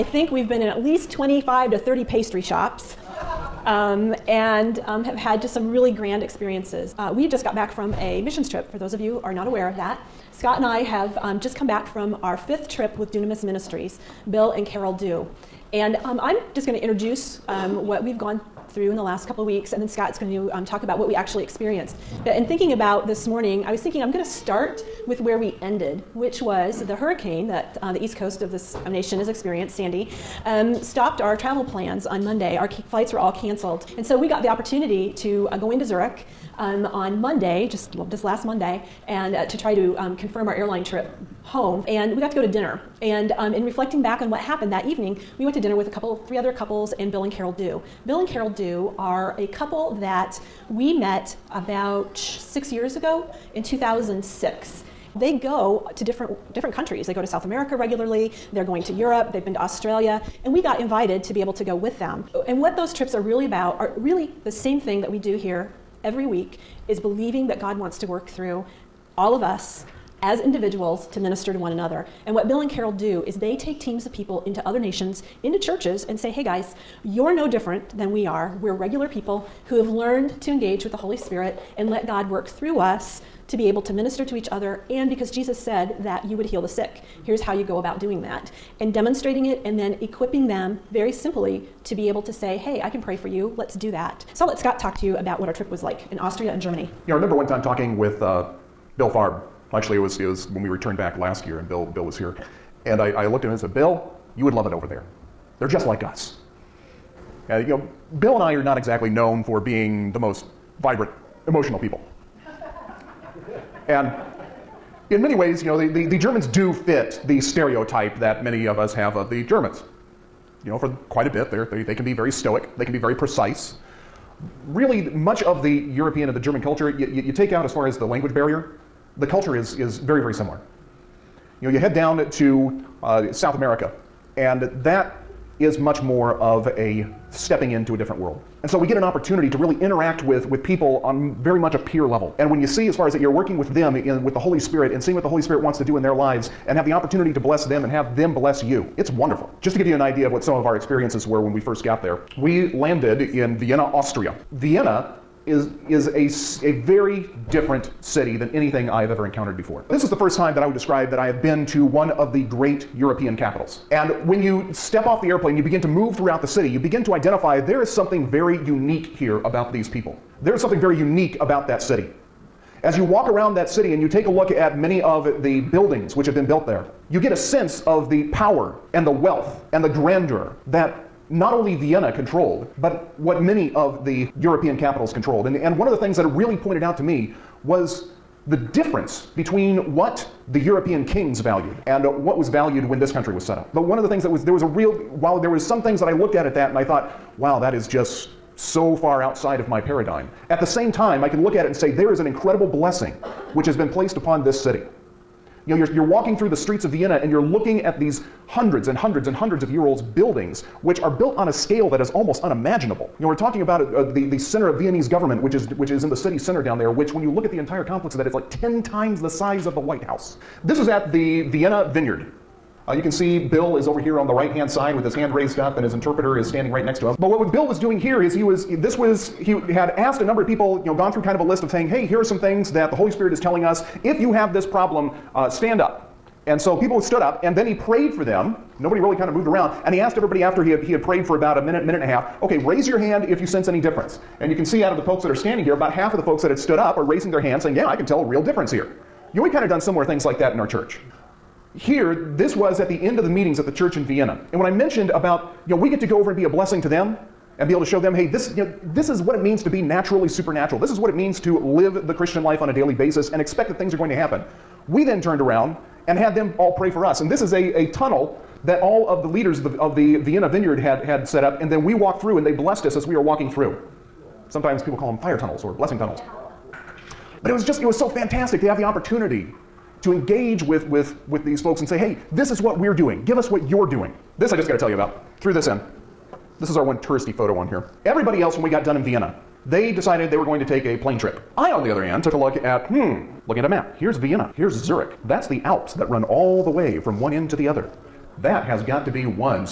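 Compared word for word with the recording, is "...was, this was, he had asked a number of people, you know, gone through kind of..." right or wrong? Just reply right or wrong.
right.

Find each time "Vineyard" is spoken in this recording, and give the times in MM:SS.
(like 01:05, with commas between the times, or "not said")
03:41, 04:30.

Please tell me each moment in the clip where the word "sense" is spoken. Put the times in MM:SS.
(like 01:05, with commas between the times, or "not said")
02:57, 04:03.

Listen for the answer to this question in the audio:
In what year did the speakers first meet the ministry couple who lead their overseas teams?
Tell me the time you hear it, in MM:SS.
00:53.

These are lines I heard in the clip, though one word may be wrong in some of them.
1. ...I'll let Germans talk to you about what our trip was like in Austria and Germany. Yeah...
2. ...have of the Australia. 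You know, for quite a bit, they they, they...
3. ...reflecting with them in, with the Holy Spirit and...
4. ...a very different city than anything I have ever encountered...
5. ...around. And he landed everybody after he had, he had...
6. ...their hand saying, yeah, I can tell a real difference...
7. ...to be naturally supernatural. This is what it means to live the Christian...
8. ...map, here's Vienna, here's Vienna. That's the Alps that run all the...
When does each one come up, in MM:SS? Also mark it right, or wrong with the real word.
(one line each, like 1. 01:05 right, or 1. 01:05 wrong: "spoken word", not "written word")
1. 01:34 wrong: "Scott", not "Germans"
2. 01:58 wrong: "Germans", not "Australia"
3. 02:23 wrong: "working", not "reflecting"
4. 02:36 right
5. 03:59 wrong: "asked", not "landed"
6. 04:07 right
7. 04:19 right
8. 04:53 wrong: "Zurich", not "Vienna".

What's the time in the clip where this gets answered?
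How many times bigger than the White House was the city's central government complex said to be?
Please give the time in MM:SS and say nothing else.
03:38.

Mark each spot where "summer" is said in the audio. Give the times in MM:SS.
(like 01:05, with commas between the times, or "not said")
not said.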